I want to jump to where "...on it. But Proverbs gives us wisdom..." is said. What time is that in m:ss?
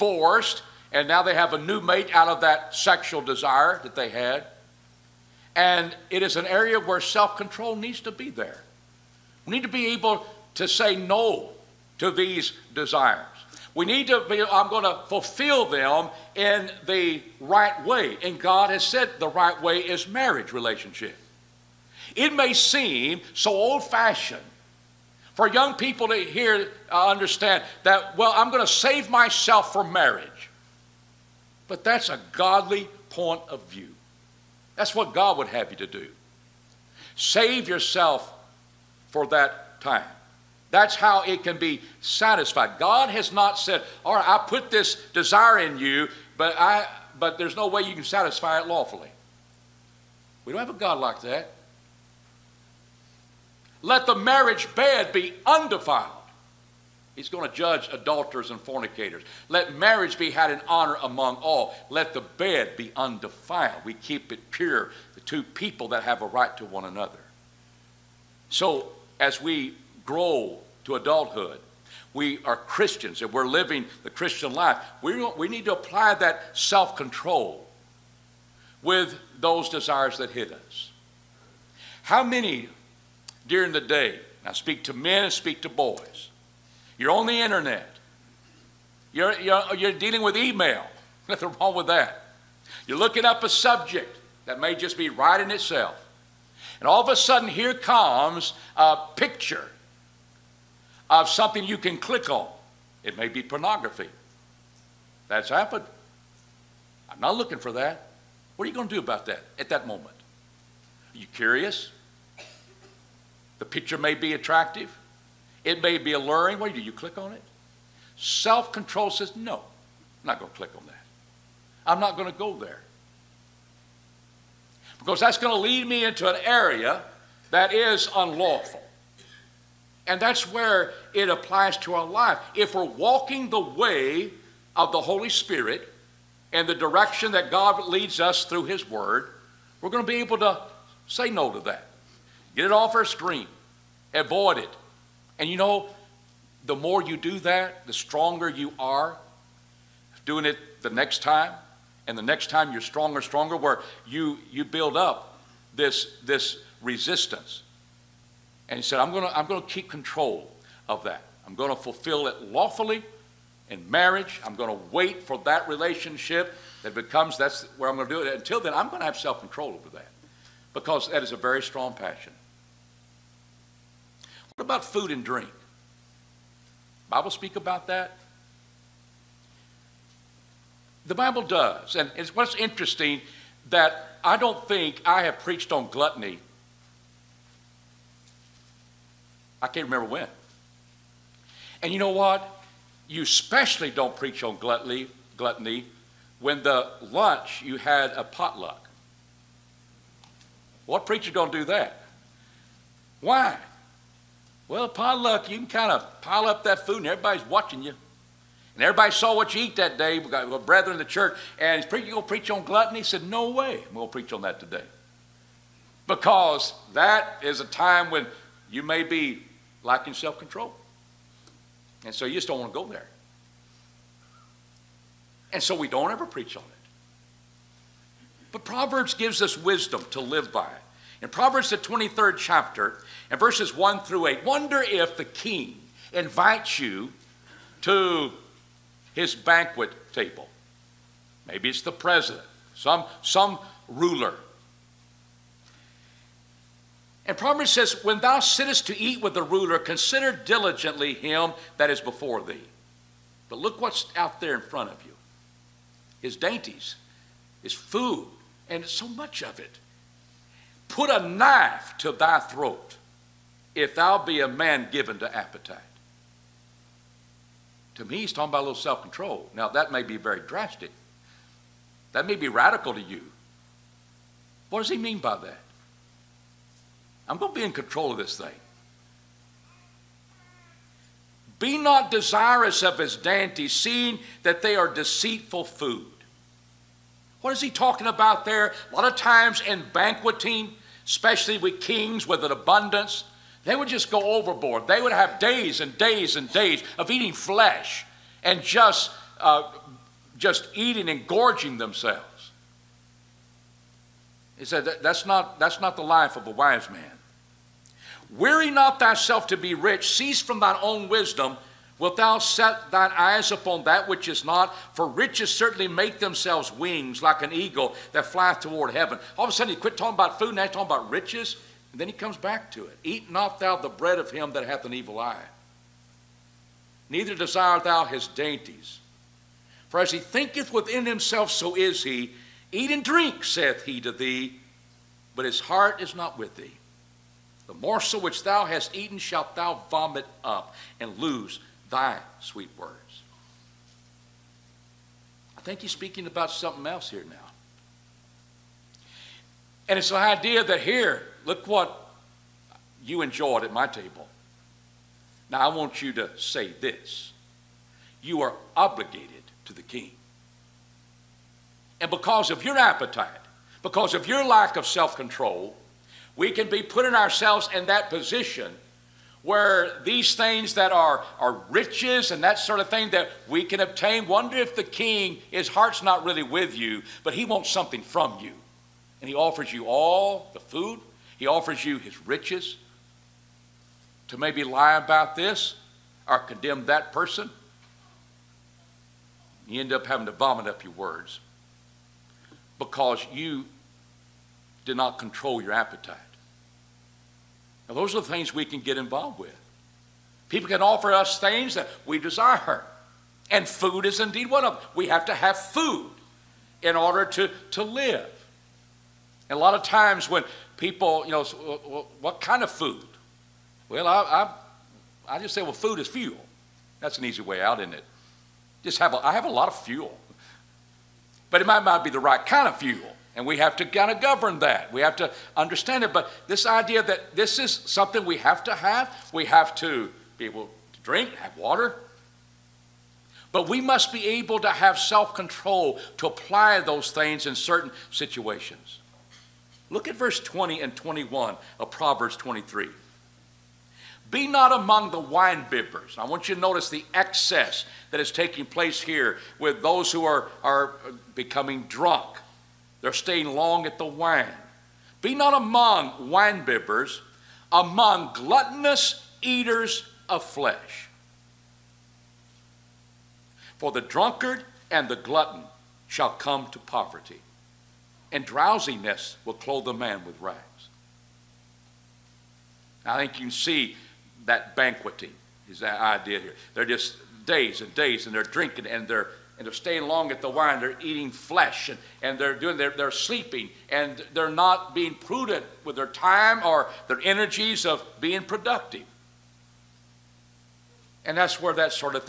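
3:46.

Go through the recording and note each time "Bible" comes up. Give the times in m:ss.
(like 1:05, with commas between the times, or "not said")
2:57, 3:01.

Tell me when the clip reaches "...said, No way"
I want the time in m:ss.
3:33.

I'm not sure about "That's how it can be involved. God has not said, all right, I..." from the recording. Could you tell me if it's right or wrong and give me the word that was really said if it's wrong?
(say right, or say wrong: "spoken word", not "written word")
wrong: "satisfied", not "involved".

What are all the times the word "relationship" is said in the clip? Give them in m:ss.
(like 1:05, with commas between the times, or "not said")
0:20, 2:45.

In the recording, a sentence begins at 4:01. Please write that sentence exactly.
Maybe it's the president, some, some ruler.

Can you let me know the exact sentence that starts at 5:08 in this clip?
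Weary not thyself to be rich, cease from thine own wisdom, Wilt thou set thine eyes upon that which is not?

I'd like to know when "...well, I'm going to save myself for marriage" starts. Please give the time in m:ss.
0:28.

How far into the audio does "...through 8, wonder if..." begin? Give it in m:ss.
3:53.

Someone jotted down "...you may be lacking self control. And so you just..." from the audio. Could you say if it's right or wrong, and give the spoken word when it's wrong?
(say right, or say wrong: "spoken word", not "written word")
right.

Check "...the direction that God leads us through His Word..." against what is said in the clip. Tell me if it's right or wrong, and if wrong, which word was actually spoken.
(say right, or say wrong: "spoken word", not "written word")
right.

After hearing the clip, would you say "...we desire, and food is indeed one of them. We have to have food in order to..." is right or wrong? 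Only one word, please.
right.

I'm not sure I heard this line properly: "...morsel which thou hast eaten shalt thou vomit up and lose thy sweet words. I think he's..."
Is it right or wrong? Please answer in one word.
right.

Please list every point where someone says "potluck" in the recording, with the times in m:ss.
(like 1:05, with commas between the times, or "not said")
3:18, 3:24.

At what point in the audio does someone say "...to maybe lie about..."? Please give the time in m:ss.
6:24.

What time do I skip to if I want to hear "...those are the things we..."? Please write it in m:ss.
6:37.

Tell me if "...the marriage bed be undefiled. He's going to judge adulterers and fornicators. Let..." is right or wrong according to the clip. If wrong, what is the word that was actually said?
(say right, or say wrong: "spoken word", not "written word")
right.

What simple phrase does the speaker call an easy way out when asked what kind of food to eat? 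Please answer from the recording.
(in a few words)
Food is fuel.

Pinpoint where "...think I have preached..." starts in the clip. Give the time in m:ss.
3:04.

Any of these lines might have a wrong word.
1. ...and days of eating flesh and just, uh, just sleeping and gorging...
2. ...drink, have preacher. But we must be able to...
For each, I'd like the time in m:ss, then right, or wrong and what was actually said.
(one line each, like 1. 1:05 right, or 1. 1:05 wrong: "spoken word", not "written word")
1. 4:56 wrong: "eating", not "sleeping"
2. 7:10 wrong: "water", not "preacher".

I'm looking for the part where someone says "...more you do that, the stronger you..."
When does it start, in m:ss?
2:26.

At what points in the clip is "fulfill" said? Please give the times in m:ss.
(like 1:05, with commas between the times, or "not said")
0:15, 2:41.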